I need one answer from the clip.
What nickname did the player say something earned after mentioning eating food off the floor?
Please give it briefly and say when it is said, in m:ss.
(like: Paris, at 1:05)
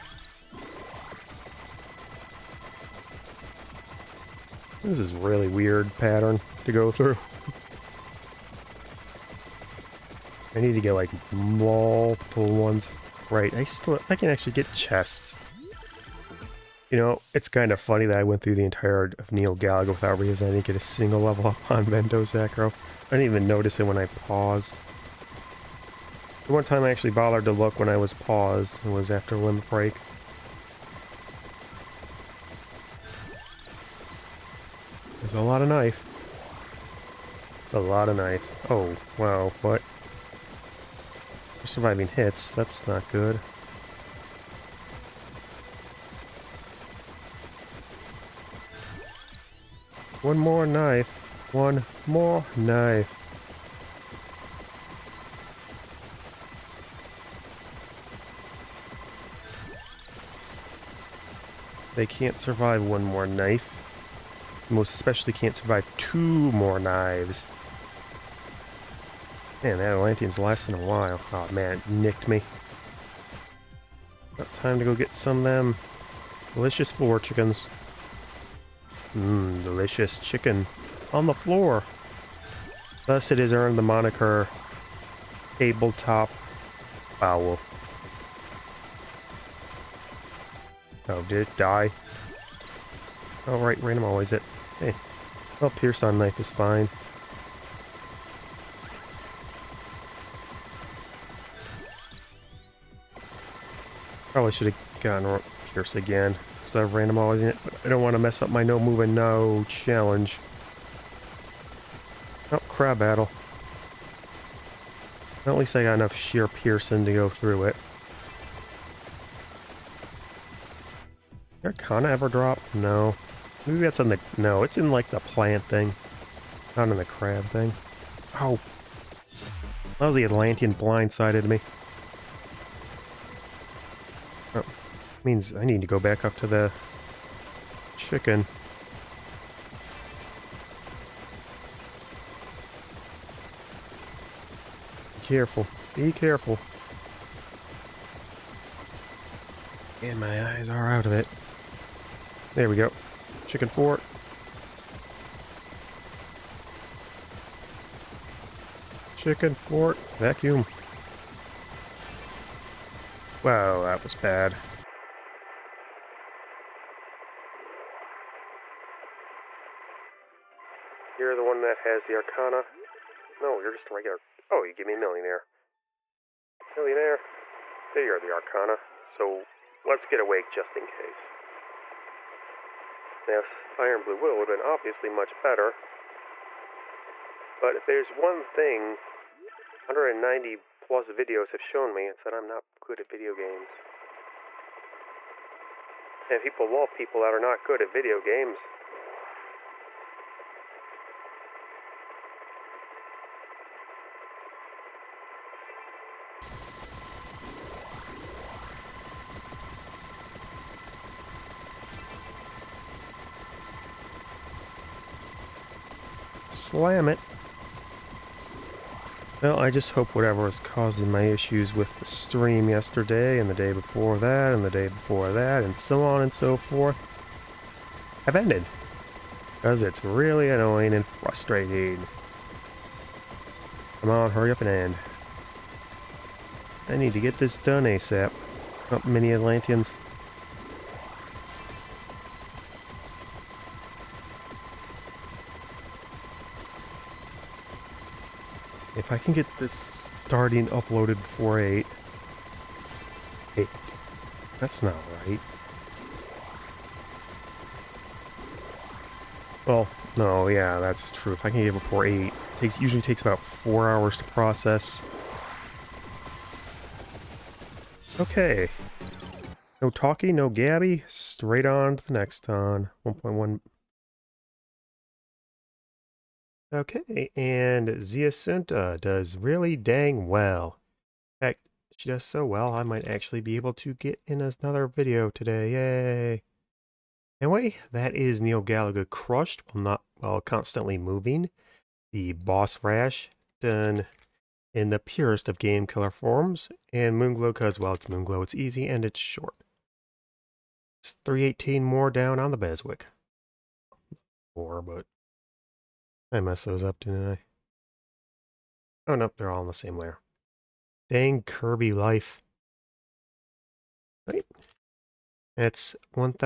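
Tabletop owl, at 1:25.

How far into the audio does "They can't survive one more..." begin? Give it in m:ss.
1:01.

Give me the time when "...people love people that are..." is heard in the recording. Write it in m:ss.
3:16.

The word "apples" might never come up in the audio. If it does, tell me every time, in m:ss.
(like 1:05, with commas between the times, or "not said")
not said.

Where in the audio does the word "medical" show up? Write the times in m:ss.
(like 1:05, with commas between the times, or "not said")
not said.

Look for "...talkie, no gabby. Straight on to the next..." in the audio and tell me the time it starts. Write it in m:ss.
4:29.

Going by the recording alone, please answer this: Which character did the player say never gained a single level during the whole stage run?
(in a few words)
Vento Sacro.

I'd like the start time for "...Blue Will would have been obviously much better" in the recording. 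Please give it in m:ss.
3:04.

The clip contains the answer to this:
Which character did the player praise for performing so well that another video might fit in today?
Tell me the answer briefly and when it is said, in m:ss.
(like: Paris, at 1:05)
Zi'Assunta, at 4:37.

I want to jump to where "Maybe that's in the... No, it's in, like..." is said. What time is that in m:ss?
2:03.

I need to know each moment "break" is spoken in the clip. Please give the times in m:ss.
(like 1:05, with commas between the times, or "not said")
0:29.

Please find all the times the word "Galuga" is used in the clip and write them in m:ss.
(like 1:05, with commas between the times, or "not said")
0:19, 4:48.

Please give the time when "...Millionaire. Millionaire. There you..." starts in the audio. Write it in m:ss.
2:54.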